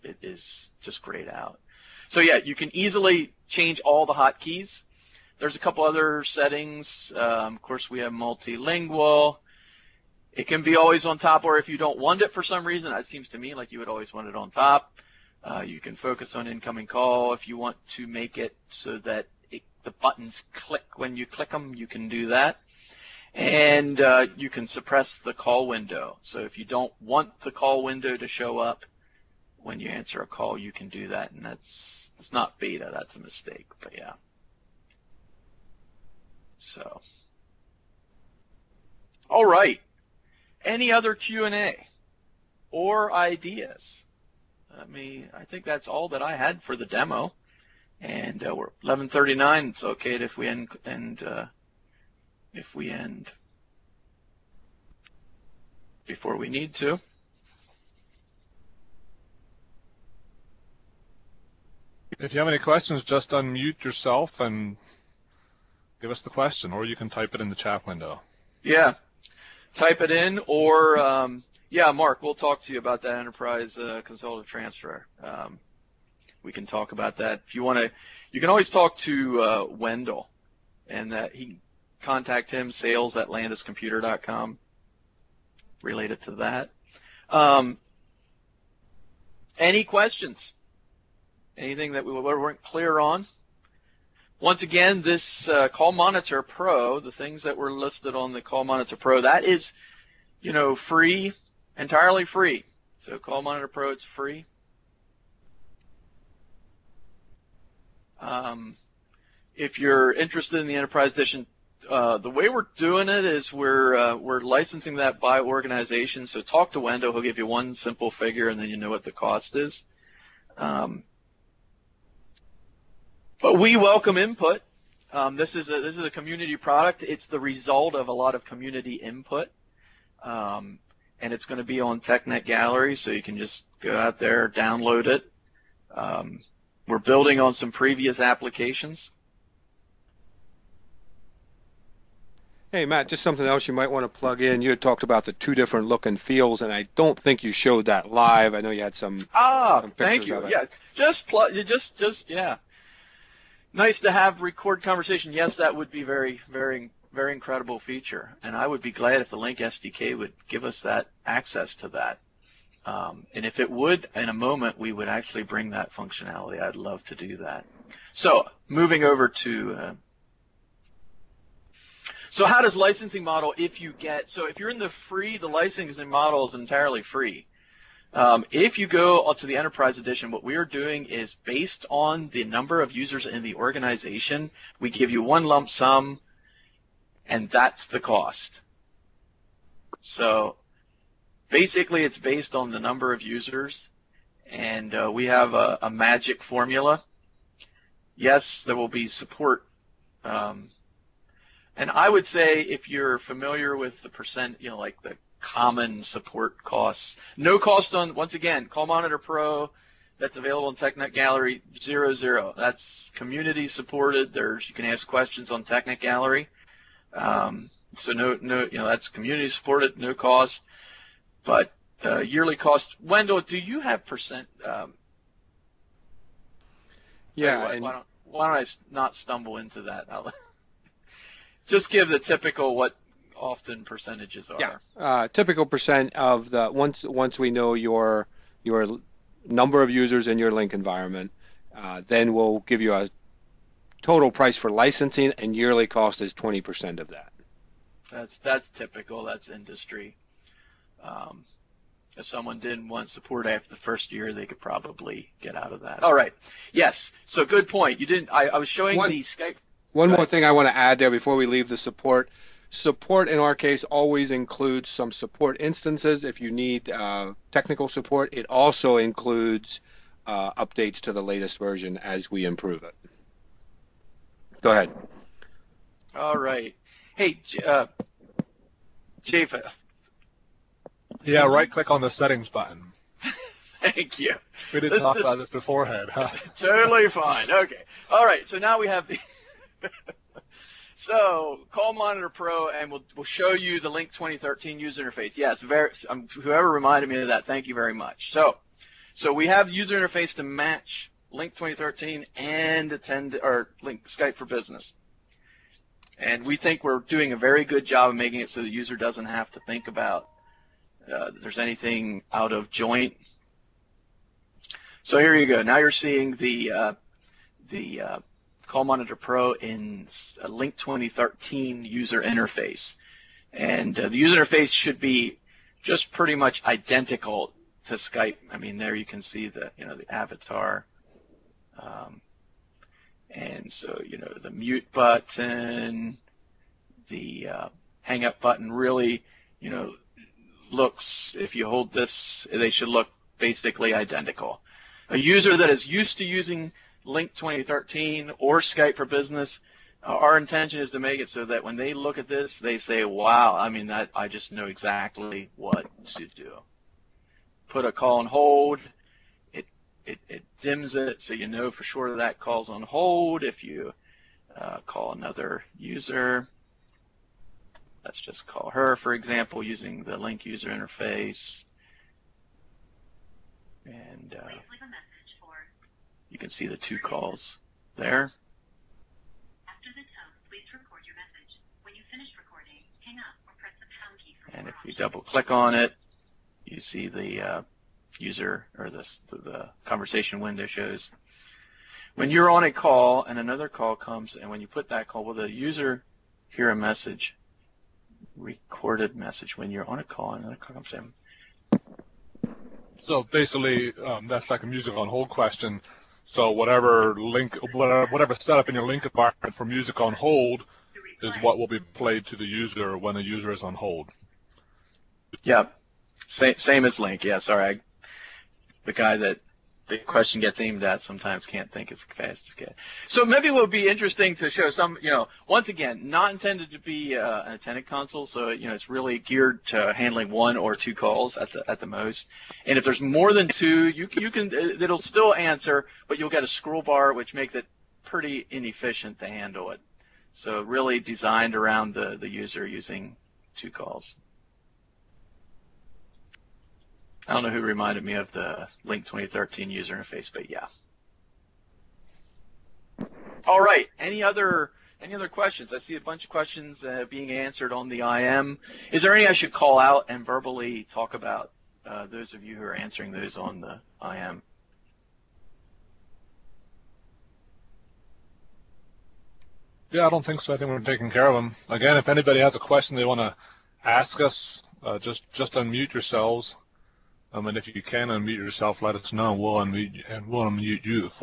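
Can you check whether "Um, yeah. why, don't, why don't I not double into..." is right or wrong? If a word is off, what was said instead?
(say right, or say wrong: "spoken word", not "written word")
wrong: "stumble", not "double".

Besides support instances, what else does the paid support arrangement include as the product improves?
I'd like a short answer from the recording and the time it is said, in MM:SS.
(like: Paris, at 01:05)
Updates to the latest version, at 04:30.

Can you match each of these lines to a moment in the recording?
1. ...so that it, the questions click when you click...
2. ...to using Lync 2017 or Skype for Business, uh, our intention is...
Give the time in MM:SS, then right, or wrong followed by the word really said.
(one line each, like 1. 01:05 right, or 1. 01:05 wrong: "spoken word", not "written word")
1. 00:18 wrong: "buttons", not "questions"
2. 05:46 wrong: "2013", not "2017".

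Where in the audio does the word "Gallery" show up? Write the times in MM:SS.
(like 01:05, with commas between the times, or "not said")
02:12, 03:31, 03:36.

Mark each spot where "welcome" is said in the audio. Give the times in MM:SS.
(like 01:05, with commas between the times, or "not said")
02:03.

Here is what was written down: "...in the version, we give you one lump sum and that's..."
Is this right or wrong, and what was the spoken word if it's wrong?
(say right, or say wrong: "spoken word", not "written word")
wrong: "organization", not "version".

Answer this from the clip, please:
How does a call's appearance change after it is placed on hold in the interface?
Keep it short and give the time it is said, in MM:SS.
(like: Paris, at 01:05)
It dims, at 06:00.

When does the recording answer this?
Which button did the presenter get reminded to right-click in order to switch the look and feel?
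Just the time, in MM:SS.
04:42.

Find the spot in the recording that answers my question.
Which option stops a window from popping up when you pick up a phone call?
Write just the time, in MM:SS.
00:24.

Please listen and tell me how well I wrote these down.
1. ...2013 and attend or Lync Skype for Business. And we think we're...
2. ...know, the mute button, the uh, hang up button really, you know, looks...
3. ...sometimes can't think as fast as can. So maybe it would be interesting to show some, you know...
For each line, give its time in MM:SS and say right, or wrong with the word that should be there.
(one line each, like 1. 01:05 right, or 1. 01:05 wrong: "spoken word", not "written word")
1. 05:01 right
2. 05:34 right
3. 07:01 right.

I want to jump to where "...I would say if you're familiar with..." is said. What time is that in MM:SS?
03:21.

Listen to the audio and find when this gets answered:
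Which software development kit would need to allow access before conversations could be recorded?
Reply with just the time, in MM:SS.
02:39.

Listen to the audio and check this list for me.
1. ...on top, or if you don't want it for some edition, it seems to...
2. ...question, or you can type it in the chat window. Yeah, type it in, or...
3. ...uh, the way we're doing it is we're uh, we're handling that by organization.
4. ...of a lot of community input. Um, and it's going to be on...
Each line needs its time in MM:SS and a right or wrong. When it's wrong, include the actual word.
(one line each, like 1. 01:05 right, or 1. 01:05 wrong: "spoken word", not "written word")
1. 00:11 wrong: "reason", not "edition"
2. 01:06 right
3. 01:51 wrong: "licensing", not "handling"
4. 02:07 right.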